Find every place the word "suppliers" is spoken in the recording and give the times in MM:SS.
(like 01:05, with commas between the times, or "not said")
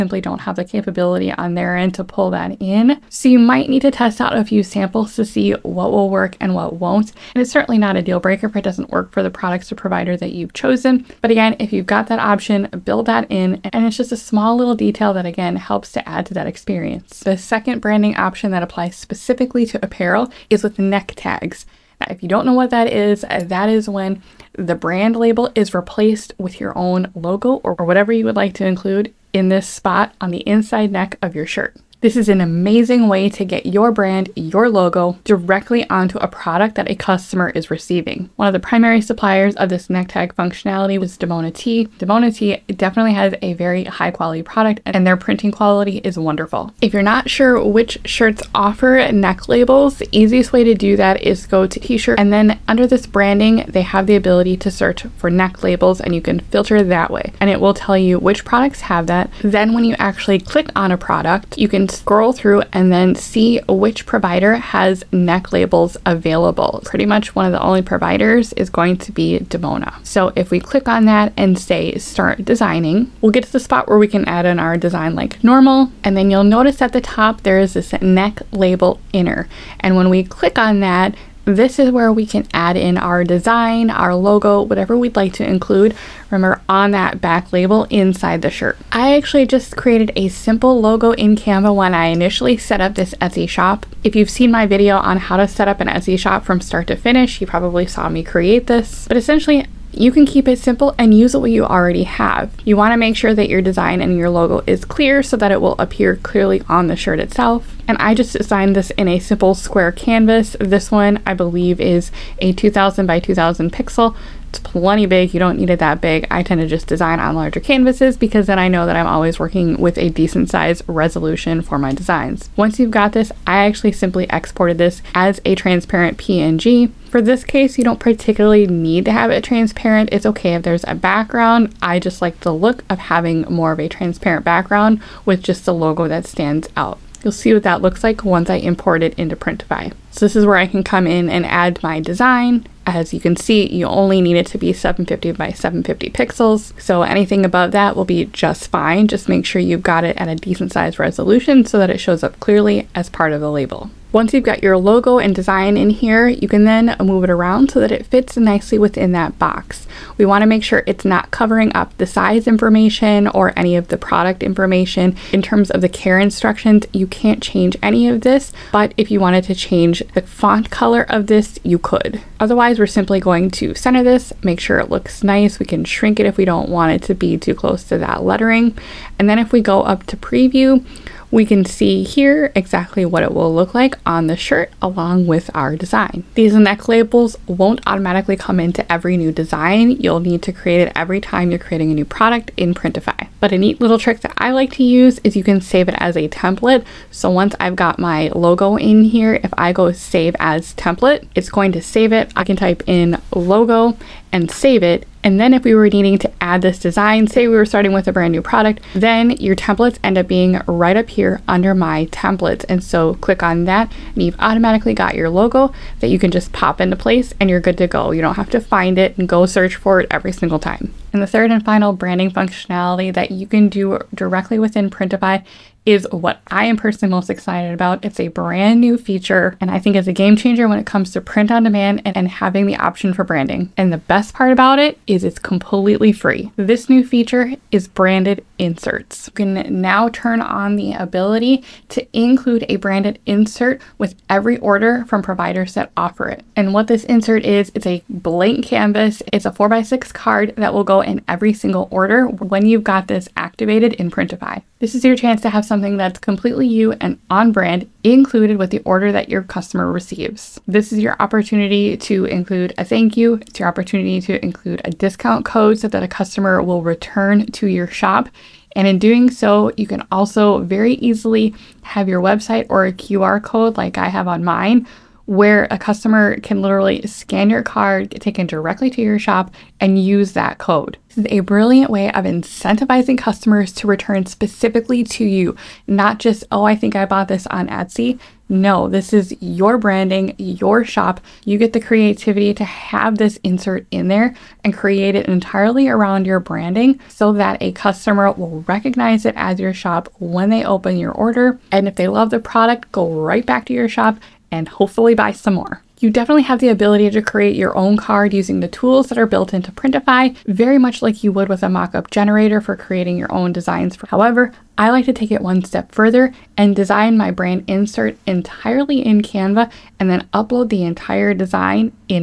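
00:39.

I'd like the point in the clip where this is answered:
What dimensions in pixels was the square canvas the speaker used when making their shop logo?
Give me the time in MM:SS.
01:52.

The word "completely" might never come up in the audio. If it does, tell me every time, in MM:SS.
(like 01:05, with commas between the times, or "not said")
03:55, 04:16.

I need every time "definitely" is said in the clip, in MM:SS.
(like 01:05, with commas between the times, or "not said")
00:42, 05:06.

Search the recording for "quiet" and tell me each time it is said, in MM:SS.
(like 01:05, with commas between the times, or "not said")
not said.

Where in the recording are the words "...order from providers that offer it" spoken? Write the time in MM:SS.
04:04.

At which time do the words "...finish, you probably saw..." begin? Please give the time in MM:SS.
01:36.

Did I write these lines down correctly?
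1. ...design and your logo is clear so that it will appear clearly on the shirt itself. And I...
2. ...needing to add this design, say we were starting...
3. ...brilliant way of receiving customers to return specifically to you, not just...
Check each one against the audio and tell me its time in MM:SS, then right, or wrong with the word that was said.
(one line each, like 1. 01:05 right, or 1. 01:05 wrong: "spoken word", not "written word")
1. 01:43 right
2. 03:25 right
3. 04:41 wrong: "incentivizing", not "receiving".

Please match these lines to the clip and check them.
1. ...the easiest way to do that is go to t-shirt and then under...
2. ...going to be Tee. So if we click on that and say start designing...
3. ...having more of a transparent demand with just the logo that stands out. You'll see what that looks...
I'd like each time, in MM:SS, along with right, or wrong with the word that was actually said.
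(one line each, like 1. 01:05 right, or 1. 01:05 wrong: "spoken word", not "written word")
1. 00:49 right
2. 01:08 wrong: "Dimona", not "Tee"
3. 02:12 wrong: "background", not "demand".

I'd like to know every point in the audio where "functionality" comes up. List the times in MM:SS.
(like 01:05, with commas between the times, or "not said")
00:40, 03:42.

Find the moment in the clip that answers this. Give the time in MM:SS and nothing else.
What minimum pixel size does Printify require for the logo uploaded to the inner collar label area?
02:24.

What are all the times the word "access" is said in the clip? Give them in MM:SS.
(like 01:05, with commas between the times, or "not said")
not said.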